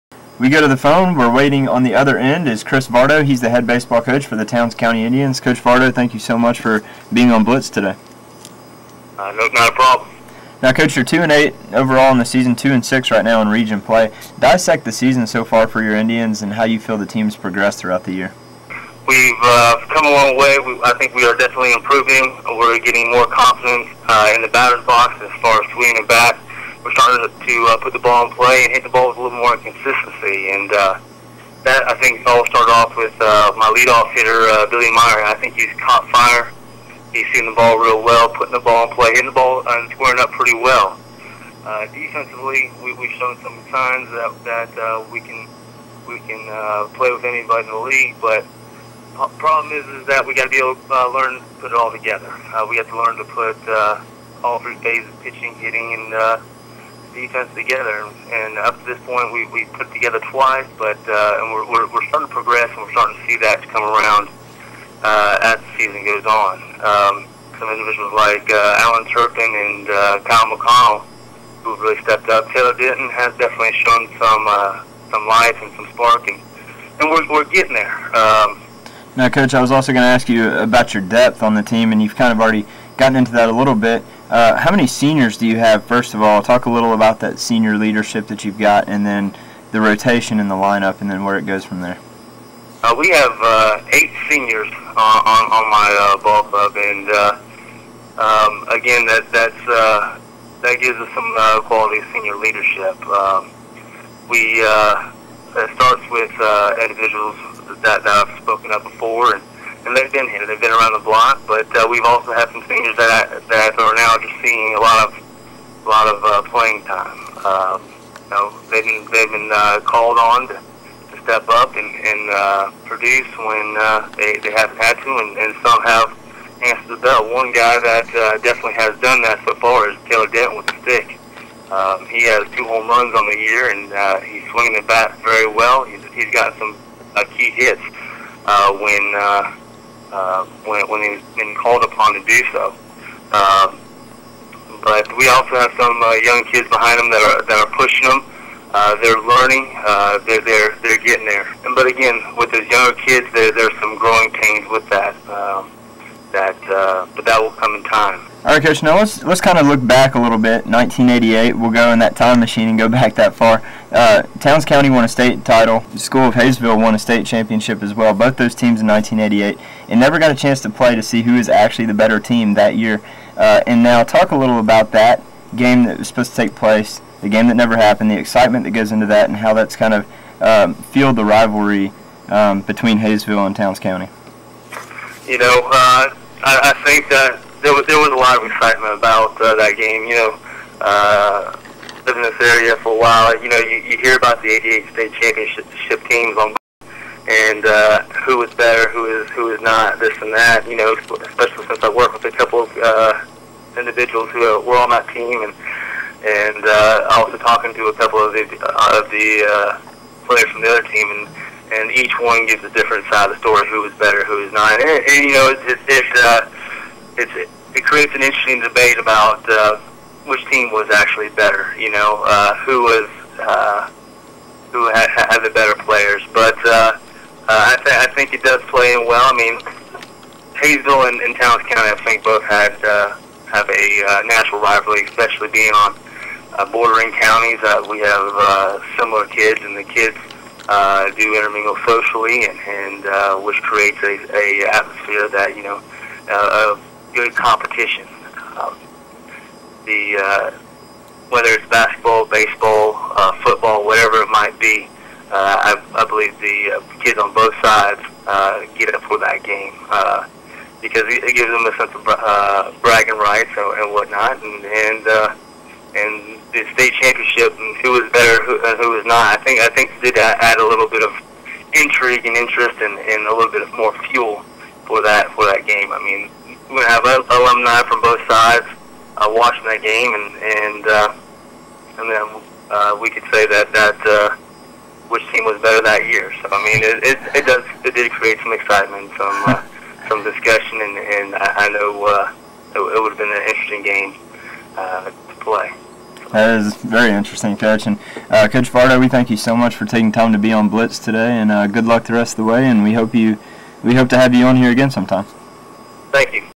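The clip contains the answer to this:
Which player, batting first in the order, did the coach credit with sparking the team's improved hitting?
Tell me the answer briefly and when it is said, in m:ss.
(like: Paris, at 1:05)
Billy Meyer, at 0:34.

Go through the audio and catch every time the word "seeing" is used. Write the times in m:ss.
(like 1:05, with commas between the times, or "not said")
1:54.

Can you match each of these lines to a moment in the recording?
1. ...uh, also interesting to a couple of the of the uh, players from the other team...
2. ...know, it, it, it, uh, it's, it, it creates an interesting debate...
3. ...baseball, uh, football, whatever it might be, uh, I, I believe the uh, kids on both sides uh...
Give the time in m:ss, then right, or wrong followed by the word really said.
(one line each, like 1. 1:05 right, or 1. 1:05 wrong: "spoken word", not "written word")
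1. 3:26 wrong: "talking", not "interesting"
2. 3:35 right
3. 4:12 right.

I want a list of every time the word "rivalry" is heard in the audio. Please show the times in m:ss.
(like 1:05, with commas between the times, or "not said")
3:01, 3:54.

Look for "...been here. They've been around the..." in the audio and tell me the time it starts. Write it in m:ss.
1:50.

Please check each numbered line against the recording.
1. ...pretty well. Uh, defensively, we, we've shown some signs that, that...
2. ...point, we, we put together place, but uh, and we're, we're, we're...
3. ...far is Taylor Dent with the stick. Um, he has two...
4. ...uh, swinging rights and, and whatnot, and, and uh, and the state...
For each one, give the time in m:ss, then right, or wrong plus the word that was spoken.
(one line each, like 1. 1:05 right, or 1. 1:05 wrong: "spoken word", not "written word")
1. 0:40 right
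2. 0:59 wrong: "twice", not "place"
3. 2:09 right
4. 4:22 wrong: "bragging", not "swinging".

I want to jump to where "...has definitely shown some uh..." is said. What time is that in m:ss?
1:13.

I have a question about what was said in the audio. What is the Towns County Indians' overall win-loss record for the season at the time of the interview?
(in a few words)
2-8.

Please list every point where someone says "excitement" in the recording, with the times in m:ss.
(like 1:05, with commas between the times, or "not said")
2:58, 3:08, 4:48.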